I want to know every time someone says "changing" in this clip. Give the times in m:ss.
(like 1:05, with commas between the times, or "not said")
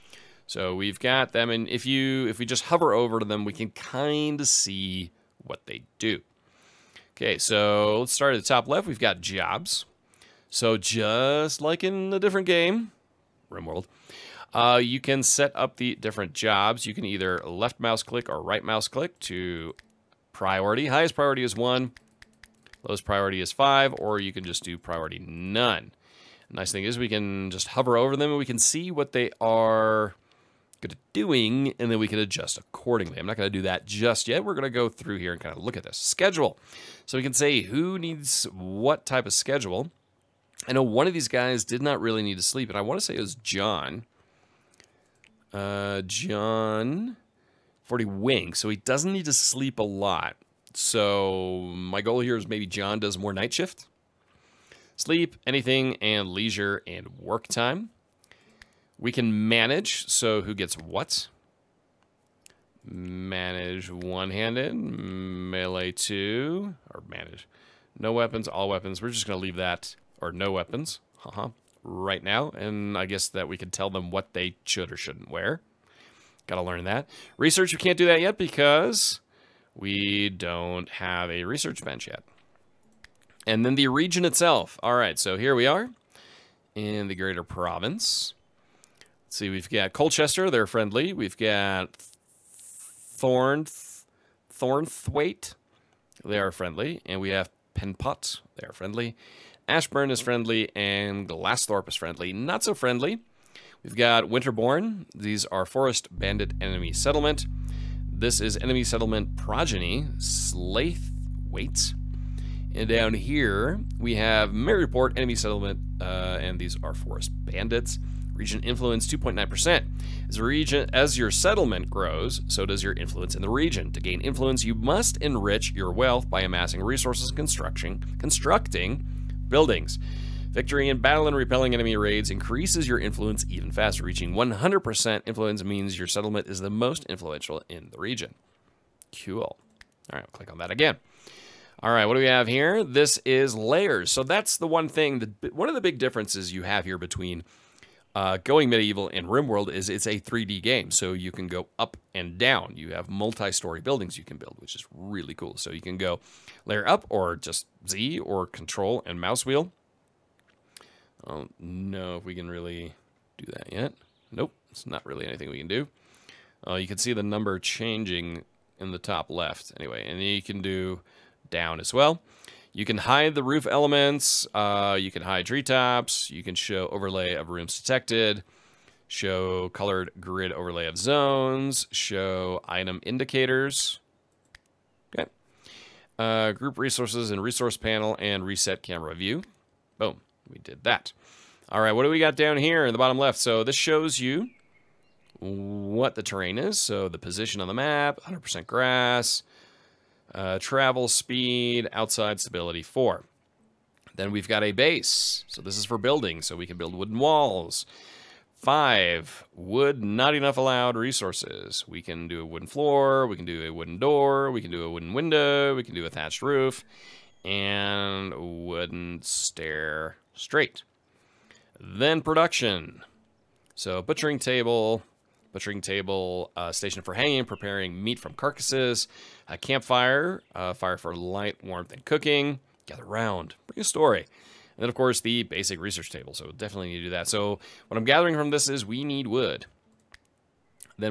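2:47.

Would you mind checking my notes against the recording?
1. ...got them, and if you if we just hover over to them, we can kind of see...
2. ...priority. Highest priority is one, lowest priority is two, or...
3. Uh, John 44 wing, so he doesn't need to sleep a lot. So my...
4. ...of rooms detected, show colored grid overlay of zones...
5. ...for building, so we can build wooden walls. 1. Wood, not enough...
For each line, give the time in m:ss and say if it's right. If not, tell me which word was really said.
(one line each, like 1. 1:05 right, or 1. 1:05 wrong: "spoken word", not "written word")
1. 0:00 right
2. 0:20 wrong: "five", not "two"
3. 0:45 wrong: "40", not "44"
4. 2:57 right
5. 3:25 wrong: "5", not "1".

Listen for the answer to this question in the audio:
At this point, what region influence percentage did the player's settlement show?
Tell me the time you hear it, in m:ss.
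1:59.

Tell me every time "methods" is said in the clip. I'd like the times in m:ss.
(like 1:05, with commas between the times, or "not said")
not said.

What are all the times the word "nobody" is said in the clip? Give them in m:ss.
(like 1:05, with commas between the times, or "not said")
not said.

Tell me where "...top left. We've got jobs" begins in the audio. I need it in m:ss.
0:08.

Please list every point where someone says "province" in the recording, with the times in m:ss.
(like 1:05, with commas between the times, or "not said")
1:27.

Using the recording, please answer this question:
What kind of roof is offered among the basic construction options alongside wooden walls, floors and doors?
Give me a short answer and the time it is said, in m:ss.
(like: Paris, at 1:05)
Thatched roof, at 3:36.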